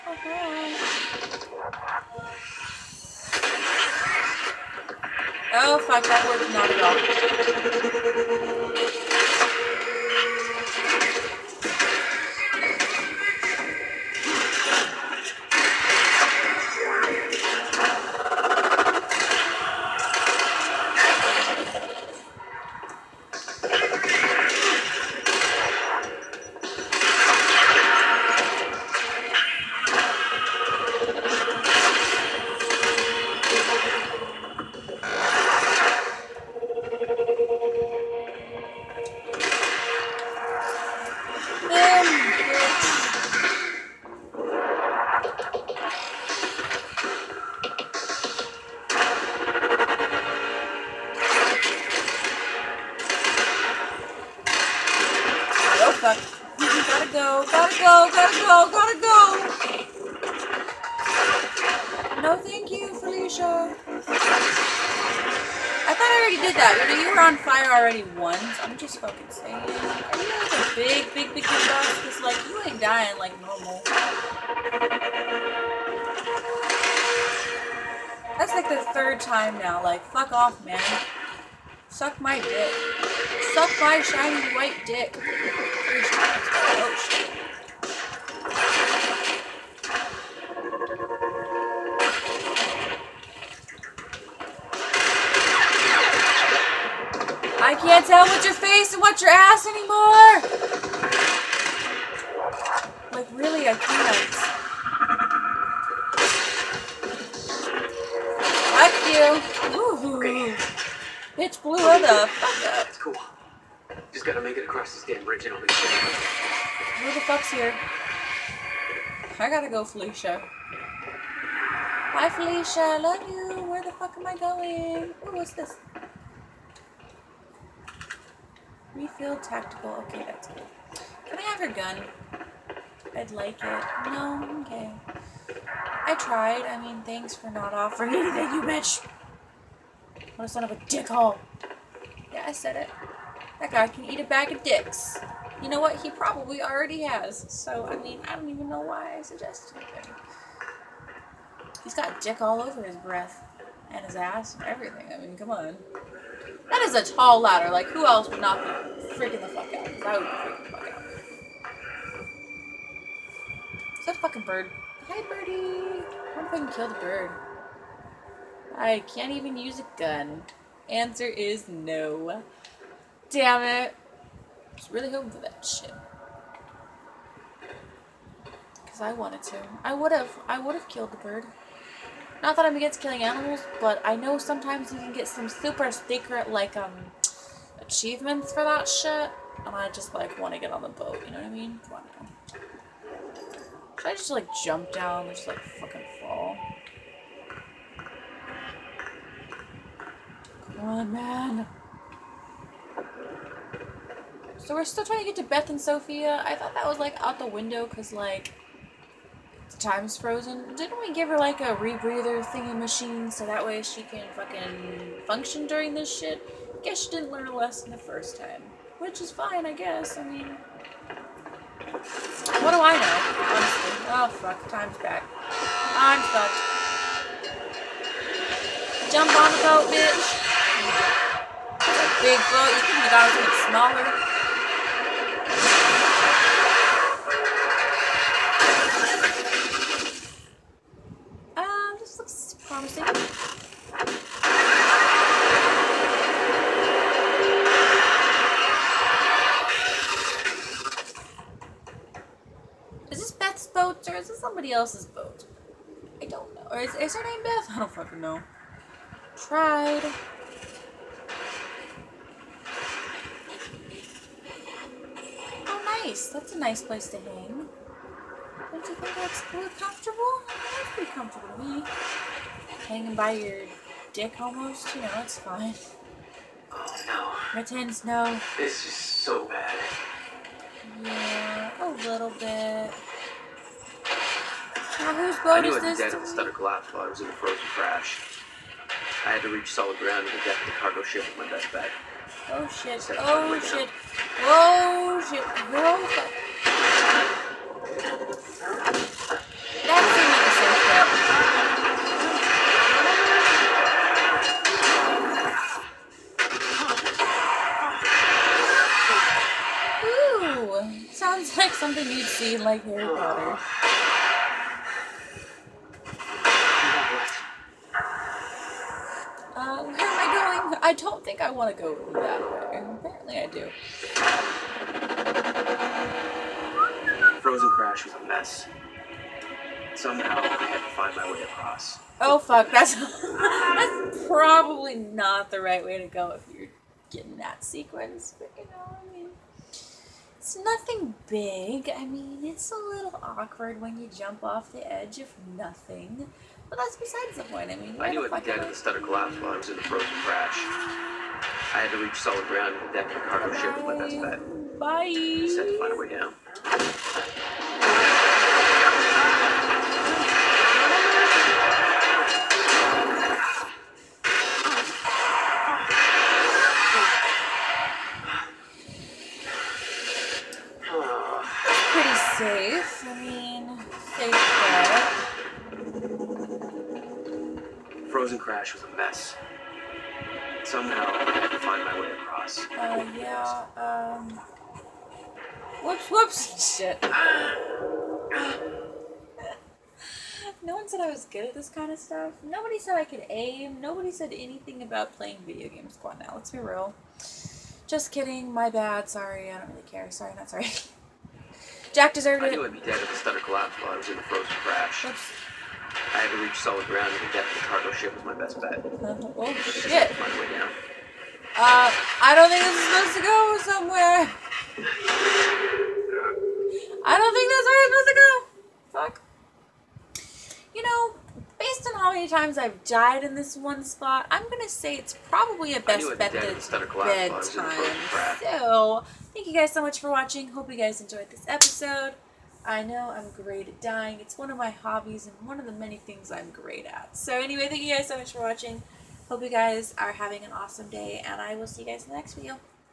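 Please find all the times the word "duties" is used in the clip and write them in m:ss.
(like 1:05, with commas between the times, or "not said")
not said.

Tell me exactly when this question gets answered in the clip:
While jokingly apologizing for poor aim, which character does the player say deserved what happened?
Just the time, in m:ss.
6:41.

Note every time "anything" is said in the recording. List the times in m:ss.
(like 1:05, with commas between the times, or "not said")
2:18, 6:34.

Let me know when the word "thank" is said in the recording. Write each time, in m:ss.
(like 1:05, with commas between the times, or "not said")
2:17, 7:09, 7:17.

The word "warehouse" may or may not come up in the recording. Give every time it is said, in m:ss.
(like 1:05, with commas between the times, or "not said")
not said.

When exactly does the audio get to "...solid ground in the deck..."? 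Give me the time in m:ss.
4:49.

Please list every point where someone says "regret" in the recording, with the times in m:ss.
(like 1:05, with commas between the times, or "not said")
not said.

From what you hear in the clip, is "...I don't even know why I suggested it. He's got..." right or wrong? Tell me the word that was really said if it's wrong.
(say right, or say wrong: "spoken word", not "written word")
right.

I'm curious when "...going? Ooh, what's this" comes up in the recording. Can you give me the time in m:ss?
2:04.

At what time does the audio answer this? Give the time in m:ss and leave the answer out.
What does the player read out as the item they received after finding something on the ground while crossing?
2:08.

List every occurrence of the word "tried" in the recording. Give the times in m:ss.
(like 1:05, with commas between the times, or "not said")
2:16, 4:19.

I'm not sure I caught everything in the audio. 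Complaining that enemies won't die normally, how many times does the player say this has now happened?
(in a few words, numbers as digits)
3.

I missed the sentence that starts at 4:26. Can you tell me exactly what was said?
That's a nice place to hang.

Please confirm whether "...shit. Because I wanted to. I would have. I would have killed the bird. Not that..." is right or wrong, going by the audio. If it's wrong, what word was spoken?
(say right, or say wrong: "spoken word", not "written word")
right.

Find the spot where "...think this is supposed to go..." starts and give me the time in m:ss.
6:52.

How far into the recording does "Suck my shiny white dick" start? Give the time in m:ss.
1:23.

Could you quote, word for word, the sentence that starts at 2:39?
Because I would be freaking the fuck out.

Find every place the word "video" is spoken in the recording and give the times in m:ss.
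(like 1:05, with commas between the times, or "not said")
6:35, 7:22.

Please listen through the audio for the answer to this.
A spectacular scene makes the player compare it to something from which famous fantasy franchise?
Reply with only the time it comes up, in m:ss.
5:12.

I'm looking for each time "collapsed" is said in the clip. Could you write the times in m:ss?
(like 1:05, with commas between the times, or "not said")
4:46, 5:48, 6:43.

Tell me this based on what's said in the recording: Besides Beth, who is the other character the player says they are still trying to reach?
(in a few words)
Sofia.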